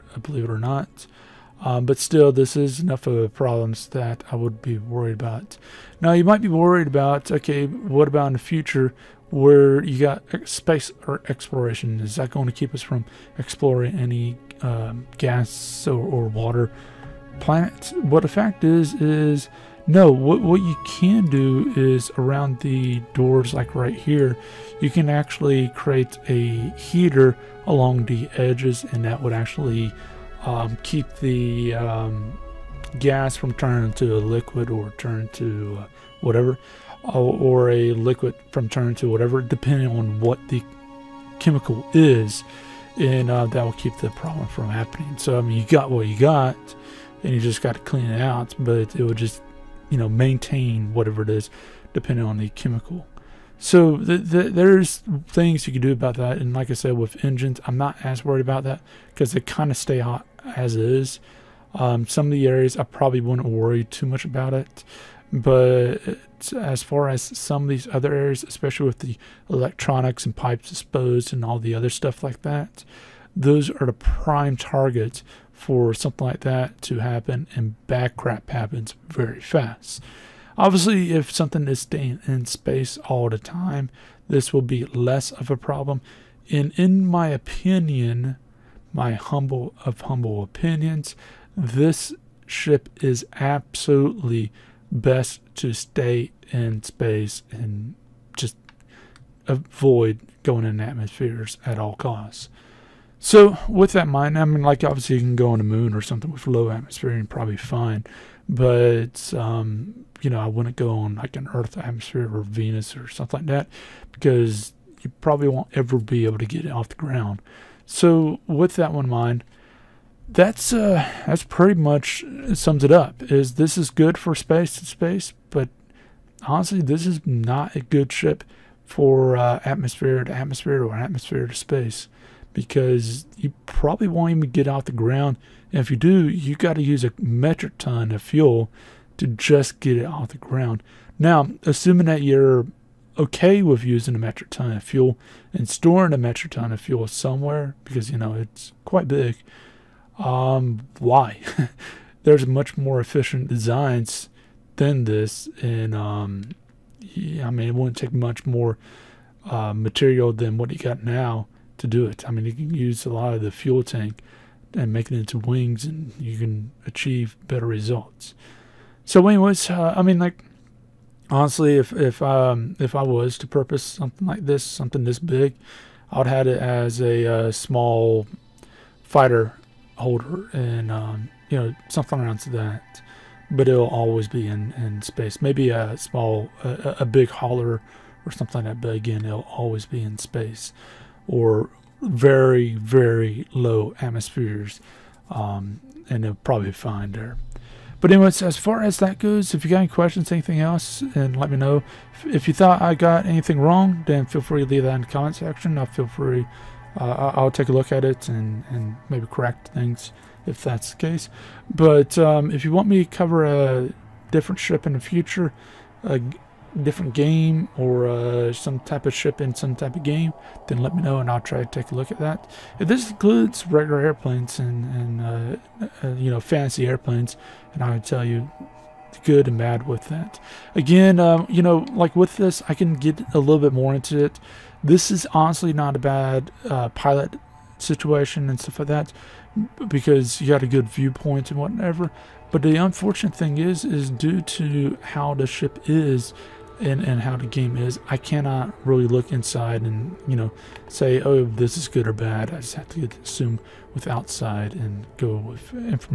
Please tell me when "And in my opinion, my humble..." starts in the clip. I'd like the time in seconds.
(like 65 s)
86 s.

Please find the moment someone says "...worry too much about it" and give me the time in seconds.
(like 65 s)
63 s.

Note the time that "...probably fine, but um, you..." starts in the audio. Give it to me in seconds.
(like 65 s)
107 s.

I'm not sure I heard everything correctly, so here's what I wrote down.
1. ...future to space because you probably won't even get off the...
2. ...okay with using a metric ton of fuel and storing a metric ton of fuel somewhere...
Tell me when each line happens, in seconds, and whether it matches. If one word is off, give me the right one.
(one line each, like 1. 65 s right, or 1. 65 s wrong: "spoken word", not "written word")
1. 130 s wrong: "atmosphere", not "future"
2. 143 s right.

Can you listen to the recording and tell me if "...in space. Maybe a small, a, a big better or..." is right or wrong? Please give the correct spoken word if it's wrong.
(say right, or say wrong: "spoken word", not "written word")
wrong: "hauler", not "better".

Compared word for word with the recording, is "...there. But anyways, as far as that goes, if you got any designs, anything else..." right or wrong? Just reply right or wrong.
wrong.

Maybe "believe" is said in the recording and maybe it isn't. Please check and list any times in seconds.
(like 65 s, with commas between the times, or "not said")
0 s.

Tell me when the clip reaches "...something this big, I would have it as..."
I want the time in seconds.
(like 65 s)
174 s.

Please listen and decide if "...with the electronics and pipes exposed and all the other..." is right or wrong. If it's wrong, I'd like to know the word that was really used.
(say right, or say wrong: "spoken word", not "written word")
right.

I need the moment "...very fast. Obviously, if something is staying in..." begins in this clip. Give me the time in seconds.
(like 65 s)
79 s.